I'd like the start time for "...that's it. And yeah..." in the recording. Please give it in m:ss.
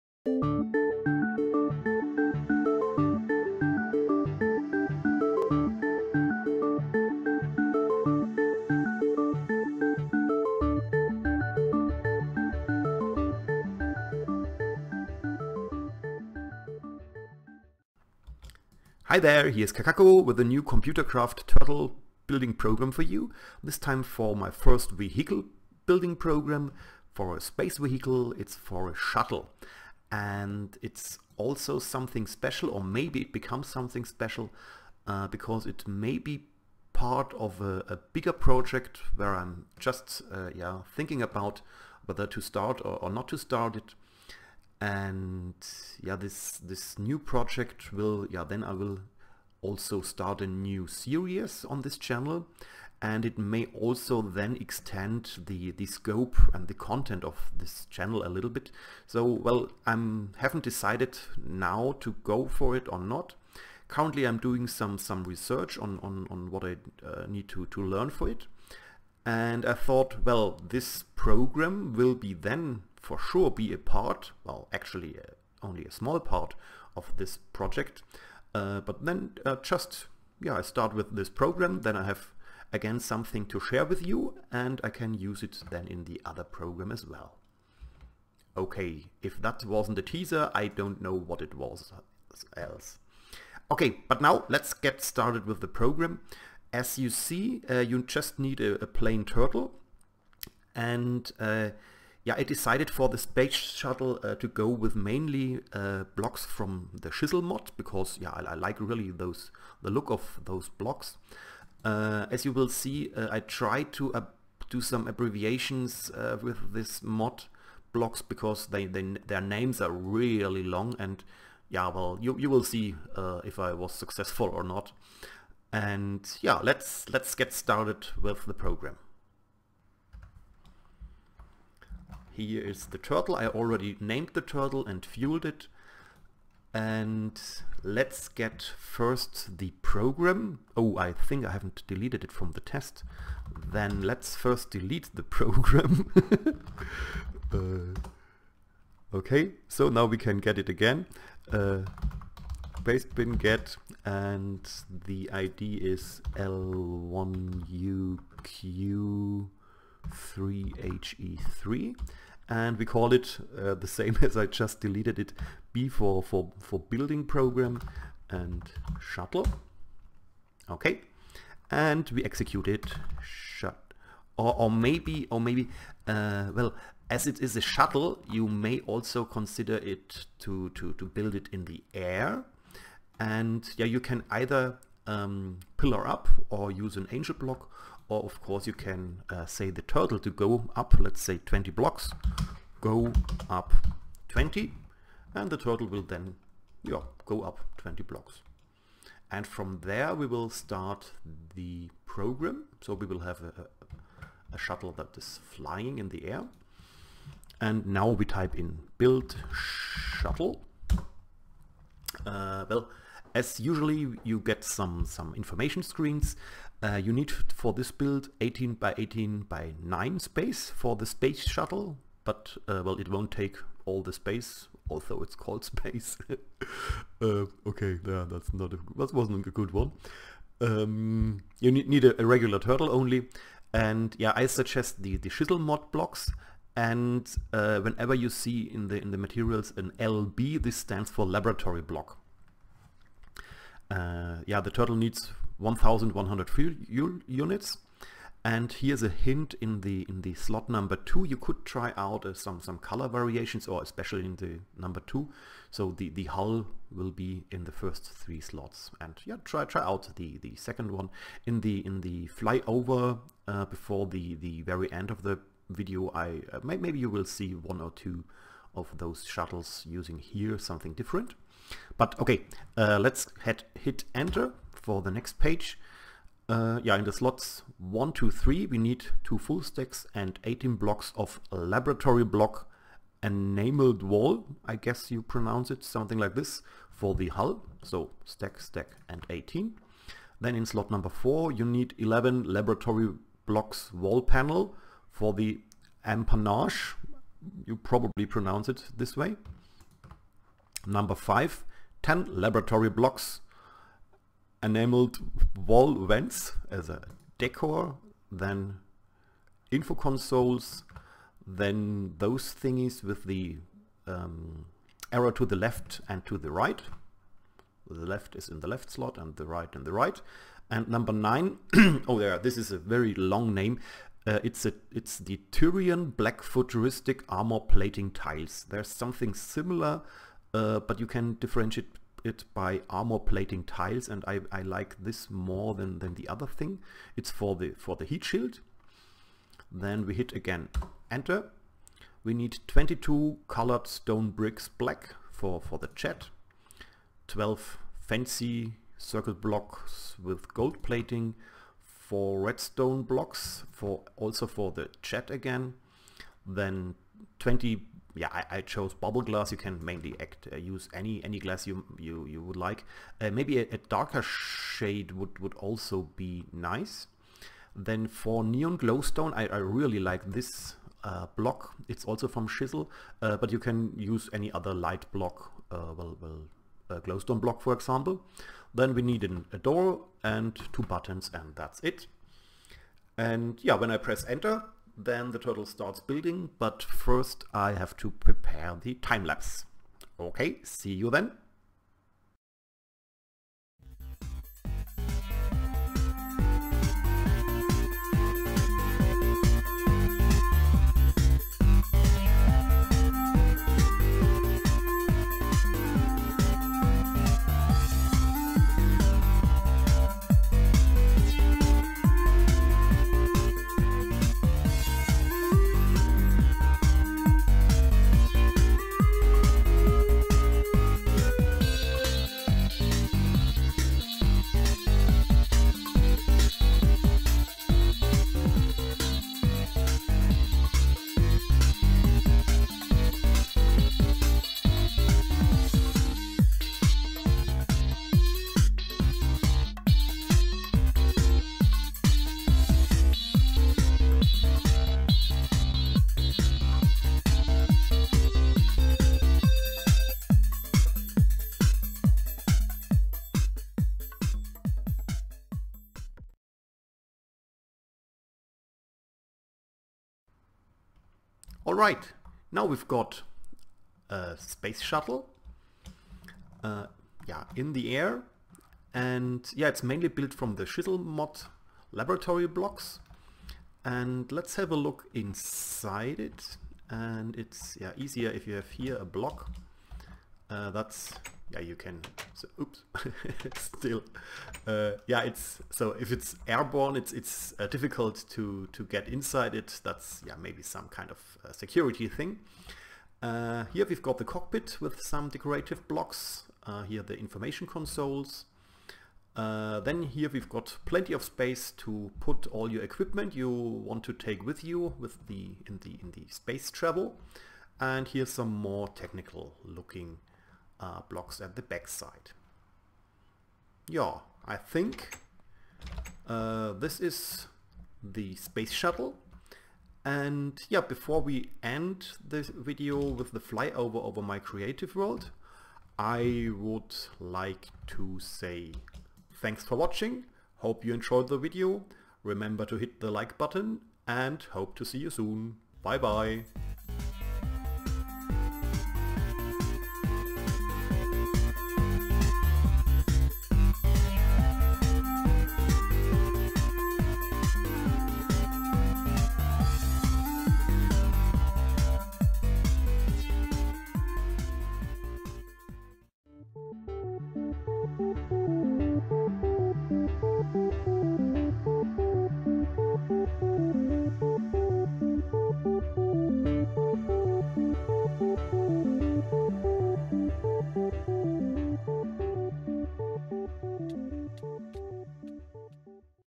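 6:21.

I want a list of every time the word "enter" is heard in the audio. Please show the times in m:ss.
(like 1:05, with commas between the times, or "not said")
4:34, 5:41, 6:24.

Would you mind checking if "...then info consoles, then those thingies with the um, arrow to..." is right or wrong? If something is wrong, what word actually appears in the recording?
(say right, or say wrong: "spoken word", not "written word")
right.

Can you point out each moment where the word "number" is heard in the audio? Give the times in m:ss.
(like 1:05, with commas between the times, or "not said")
4:10, 4:14, 4:50, 5:00, 5:20.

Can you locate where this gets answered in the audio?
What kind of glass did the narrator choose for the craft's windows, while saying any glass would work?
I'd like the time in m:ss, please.
5:58.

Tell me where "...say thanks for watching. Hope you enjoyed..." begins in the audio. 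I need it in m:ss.
8:48.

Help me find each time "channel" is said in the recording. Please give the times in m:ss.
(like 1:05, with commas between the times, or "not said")
0:51, 0:57.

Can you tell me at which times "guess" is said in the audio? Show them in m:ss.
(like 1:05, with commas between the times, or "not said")
4:44.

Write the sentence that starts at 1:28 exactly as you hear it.
Okay, if that wasn't a teaser, I don't know what it was else.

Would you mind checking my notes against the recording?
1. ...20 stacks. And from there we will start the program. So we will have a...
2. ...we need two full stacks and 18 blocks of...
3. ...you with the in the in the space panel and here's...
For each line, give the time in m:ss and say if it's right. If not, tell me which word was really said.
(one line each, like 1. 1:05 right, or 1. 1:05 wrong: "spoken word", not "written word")
1. 3:17 wrong: "blocks", not "stacks"
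2. 4:38 right
3. 8:24 wrong: "travel", not "panel".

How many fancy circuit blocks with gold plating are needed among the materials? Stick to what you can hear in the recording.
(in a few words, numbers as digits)
12.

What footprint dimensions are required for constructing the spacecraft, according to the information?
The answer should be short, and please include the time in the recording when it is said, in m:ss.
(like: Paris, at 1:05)
18 by 18 by 9, at 3:38.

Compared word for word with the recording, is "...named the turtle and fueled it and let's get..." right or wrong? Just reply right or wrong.
right.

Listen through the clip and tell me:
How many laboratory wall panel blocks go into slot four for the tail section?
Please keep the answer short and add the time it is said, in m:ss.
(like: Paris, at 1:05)
11, at 4:51.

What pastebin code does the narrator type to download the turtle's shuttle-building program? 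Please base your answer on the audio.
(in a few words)
L1UQ3HE3.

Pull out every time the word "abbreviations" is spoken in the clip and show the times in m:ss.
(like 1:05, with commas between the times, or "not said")
1:55.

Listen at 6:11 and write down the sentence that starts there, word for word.
It's also from Chisel, uh, but you can use any other light block, uh, well, well uh, glowstone block for example.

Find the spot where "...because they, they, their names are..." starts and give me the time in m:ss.
1:58.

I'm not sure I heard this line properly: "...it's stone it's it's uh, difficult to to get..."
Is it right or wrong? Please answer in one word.
wrong.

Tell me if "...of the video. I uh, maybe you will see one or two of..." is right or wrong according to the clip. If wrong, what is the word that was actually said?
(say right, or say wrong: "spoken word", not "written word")
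right.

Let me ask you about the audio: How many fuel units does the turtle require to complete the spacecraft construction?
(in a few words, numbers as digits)
1,100.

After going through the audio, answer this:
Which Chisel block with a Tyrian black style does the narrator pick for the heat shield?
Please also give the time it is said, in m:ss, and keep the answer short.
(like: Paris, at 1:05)
futuristic armor plating tiles, at 5:26.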